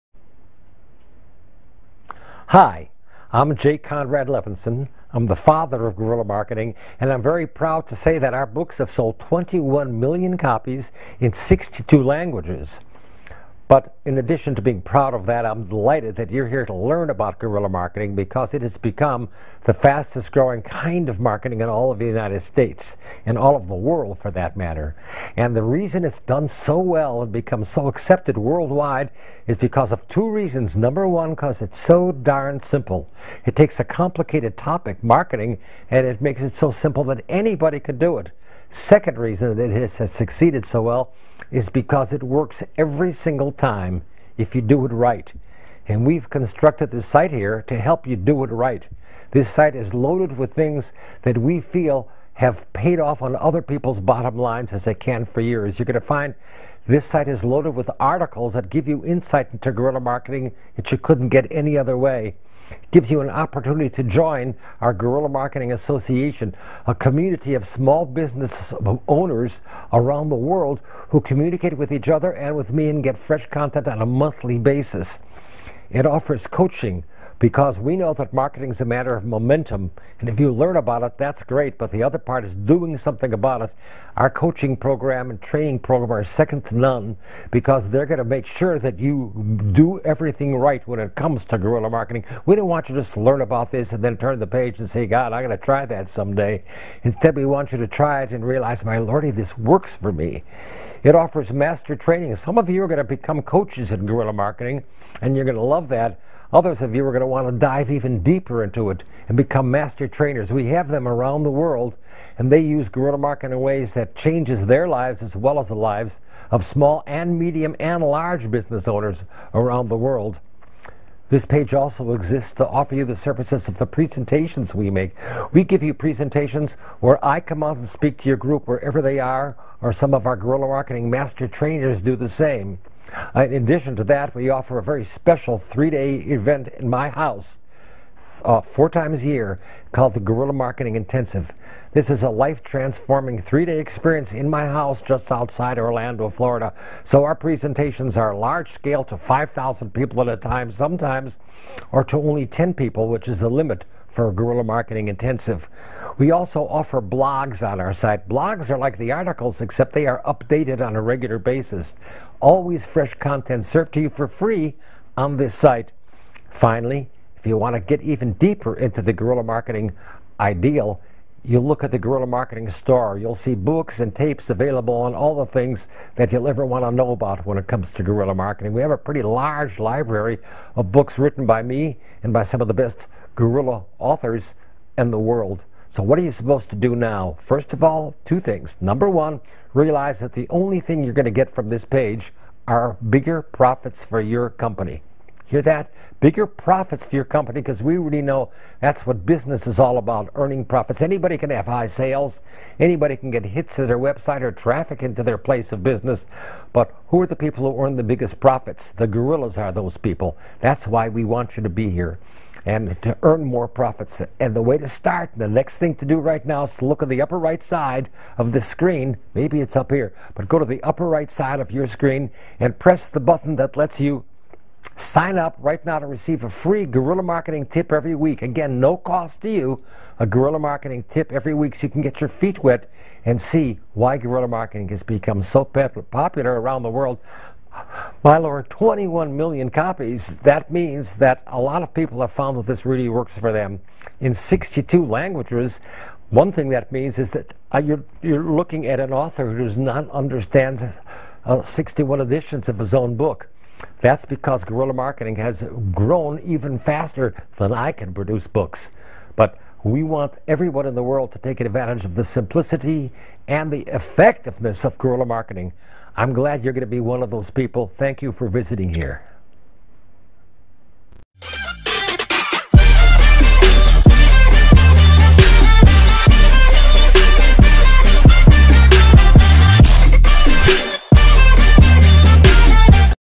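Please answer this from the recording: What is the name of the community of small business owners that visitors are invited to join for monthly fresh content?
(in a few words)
Guerrilla Marketing Association.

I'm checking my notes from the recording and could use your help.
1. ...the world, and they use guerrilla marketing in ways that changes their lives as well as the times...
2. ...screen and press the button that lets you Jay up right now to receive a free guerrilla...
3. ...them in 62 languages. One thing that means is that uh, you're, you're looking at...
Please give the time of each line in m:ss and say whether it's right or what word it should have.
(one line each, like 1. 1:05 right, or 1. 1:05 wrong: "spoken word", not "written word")
1. 1:51 wrong: "lives", not "times"
2. 3:41 wrong: "Sign", not "Jay"
3. 4:03 right.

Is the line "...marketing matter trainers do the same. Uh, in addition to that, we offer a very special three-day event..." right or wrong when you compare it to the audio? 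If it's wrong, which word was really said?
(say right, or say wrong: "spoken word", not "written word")
wrong: "master", not "matter".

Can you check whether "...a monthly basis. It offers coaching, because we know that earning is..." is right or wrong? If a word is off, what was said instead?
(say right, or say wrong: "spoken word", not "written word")
wrong: "marketing", not "earning".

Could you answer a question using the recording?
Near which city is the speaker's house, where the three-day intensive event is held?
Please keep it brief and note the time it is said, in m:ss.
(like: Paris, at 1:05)
Orlando, Florida, at 2:25.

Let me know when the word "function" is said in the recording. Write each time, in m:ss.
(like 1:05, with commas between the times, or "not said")
not said.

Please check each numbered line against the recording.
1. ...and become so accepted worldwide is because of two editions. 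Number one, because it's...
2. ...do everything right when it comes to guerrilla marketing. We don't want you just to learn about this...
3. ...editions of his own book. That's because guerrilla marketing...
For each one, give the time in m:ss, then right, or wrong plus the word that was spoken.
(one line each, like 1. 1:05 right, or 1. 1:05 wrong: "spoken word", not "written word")
1. 0:27 wrong: "reasons", not "editions"
2. 1:29 right
3. 4:12 right.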